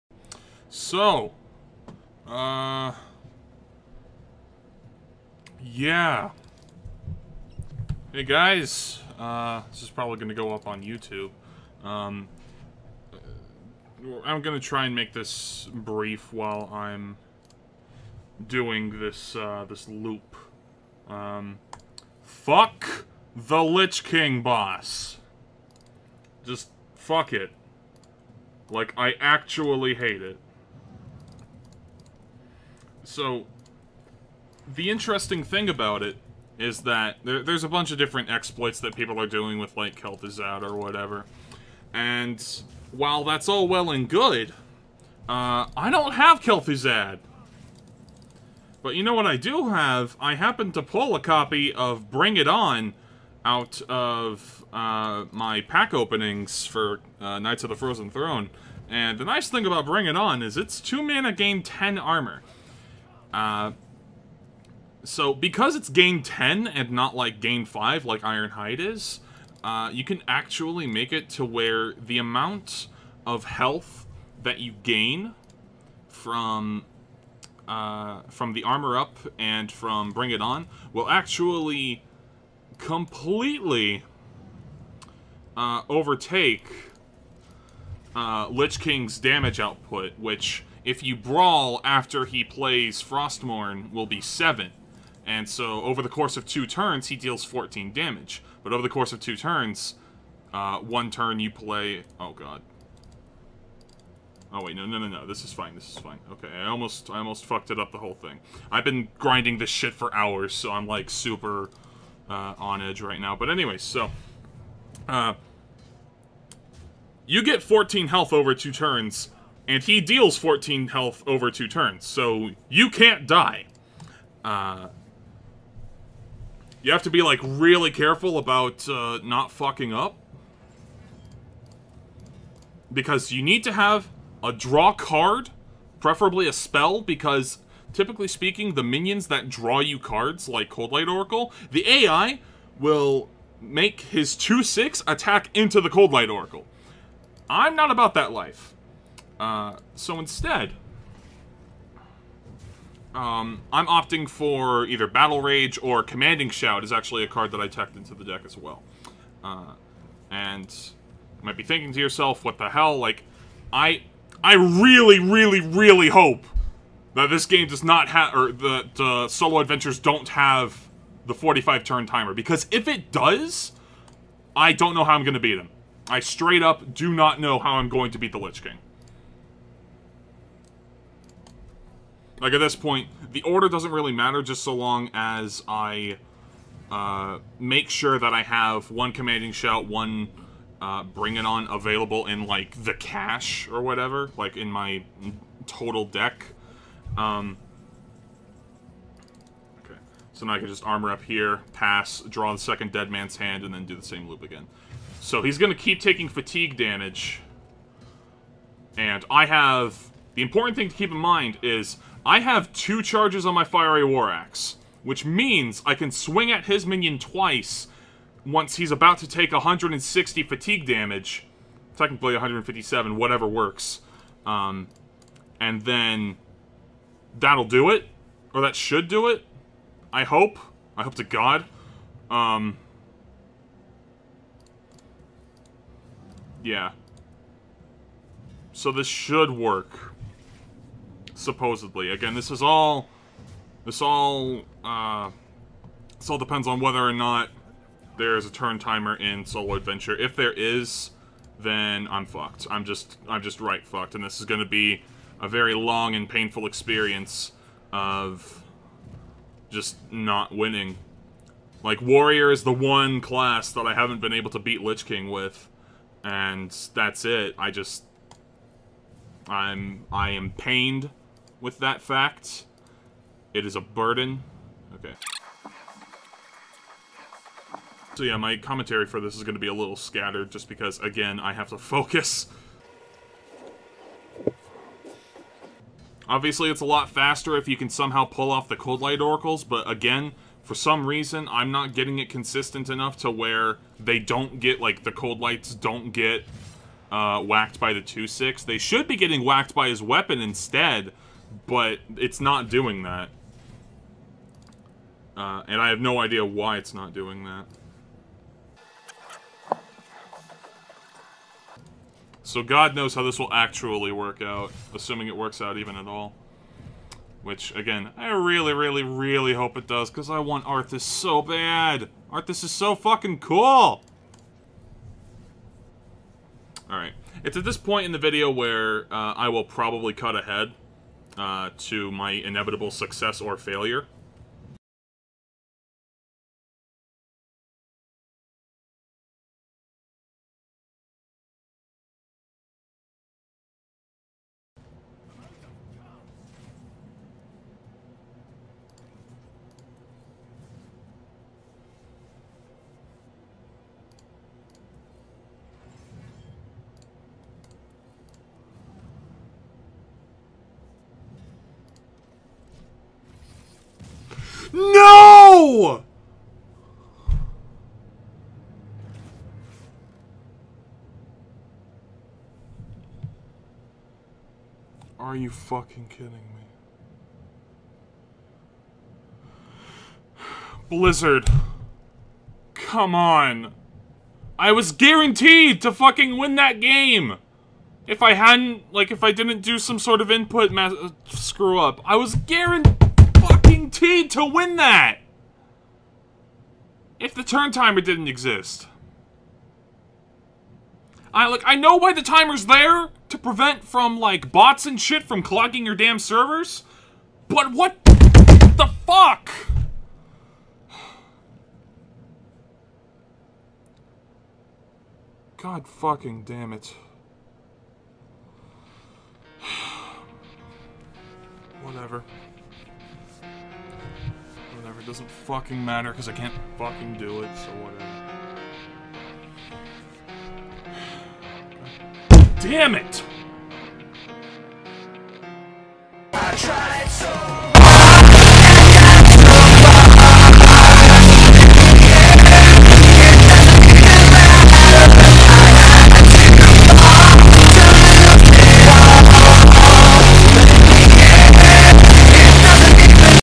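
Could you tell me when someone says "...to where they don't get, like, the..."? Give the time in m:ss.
4:53.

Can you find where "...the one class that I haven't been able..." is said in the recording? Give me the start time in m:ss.
4:22.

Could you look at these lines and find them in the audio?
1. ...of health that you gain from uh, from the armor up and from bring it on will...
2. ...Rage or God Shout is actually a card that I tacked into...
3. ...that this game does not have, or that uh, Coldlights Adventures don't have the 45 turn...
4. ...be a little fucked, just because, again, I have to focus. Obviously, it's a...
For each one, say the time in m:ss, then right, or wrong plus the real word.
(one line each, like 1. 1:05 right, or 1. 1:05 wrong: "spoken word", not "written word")
1. 1:13 right
2. 2:35 wrong: "Commanding", not "God"
3. 2:47 wrong: "Solo", not "Coldlights"
4. 4:39 wrong: "scattered", not "fucked".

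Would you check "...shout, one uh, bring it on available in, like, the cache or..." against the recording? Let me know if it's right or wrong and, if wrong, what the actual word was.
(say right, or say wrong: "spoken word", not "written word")
right.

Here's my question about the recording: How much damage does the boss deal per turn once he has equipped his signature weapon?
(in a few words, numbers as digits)
7.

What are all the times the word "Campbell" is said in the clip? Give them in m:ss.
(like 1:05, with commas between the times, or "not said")
not said.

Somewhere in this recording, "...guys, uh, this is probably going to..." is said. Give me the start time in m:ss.
0:08.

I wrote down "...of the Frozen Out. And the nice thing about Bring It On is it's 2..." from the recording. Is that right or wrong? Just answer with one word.
wrong.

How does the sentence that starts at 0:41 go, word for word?
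And while that's all well and good, uh, I don't have Kel'Thuzad.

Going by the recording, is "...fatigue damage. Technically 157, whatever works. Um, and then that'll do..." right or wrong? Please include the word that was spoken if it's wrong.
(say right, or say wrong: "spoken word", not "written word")
right.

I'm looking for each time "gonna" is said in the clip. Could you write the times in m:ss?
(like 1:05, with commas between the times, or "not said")
4:14.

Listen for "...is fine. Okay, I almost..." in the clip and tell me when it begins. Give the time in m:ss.
1:45.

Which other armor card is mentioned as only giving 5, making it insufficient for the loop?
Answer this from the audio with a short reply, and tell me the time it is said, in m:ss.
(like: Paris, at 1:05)
Ironhide, at 1:08.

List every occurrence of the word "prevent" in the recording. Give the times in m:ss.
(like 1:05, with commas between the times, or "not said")
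6:43.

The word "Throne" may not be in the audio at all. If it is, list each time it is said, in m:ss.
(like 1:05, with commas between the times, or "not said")
0:58.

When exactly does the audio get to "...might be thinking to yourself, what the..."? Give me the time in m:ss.
2:41.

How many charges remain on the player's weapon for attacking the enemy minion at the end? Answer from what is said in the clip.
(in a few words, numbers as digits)
2.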